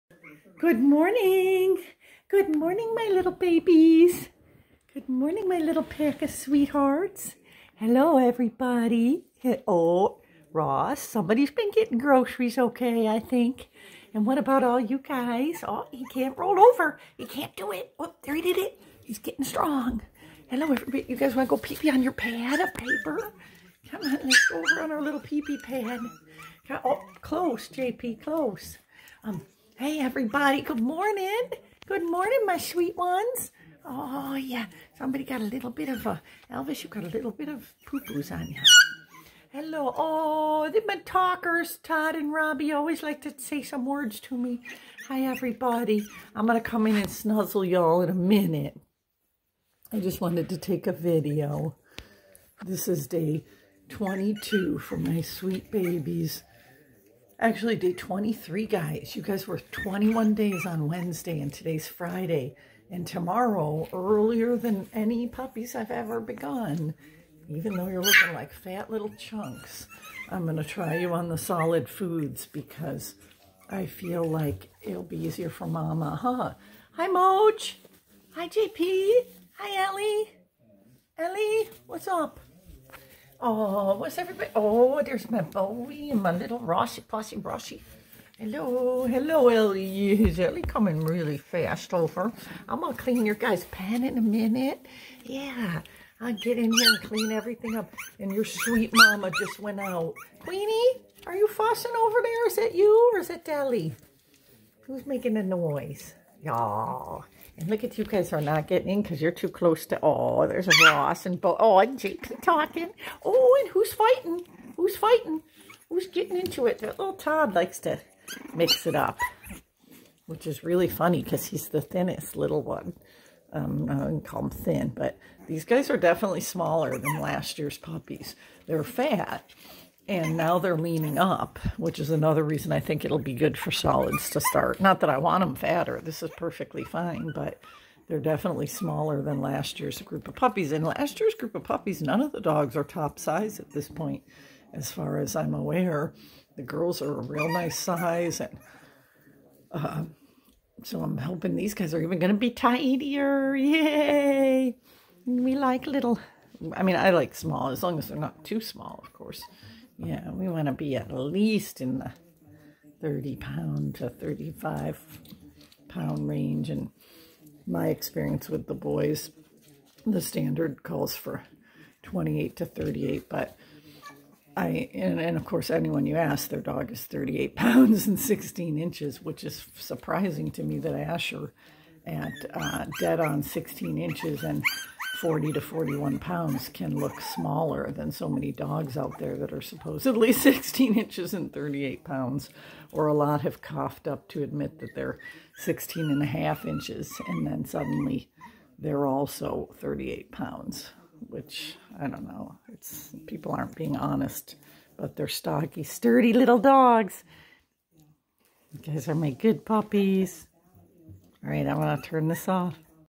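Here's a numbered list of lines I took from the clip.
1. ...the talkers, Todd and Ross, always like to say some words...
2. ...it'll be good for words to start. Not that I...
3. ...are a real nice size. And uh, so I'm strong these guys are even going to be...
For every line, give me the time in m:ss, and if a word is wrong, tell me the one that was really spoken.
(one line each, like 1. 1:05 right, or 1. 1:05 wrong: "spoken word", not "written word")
1. 0:40 wrong: "Robbie", not "Ross"
2. 2:13 wrong: "solids", not "words"
3. 2:27 wrong: "hoping", not "strong".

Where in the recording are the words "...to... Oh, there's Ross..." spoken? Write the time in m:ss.
1:49.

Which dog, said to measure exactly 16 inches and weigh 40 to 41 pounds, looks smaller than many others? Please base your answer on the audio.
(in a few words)
Asher.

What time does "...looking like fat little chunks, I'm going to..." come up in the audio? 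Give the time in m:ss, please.
1:08.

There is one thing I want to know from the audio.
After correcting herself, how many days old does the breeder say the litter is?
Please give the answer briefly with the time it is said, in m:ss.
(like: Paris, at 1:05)
23, at 0:57.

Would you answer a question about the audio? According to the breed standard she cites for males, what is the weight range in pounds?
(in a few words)
28 to 38.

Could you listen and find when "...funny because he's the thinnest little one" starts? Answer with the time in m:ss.
2:00.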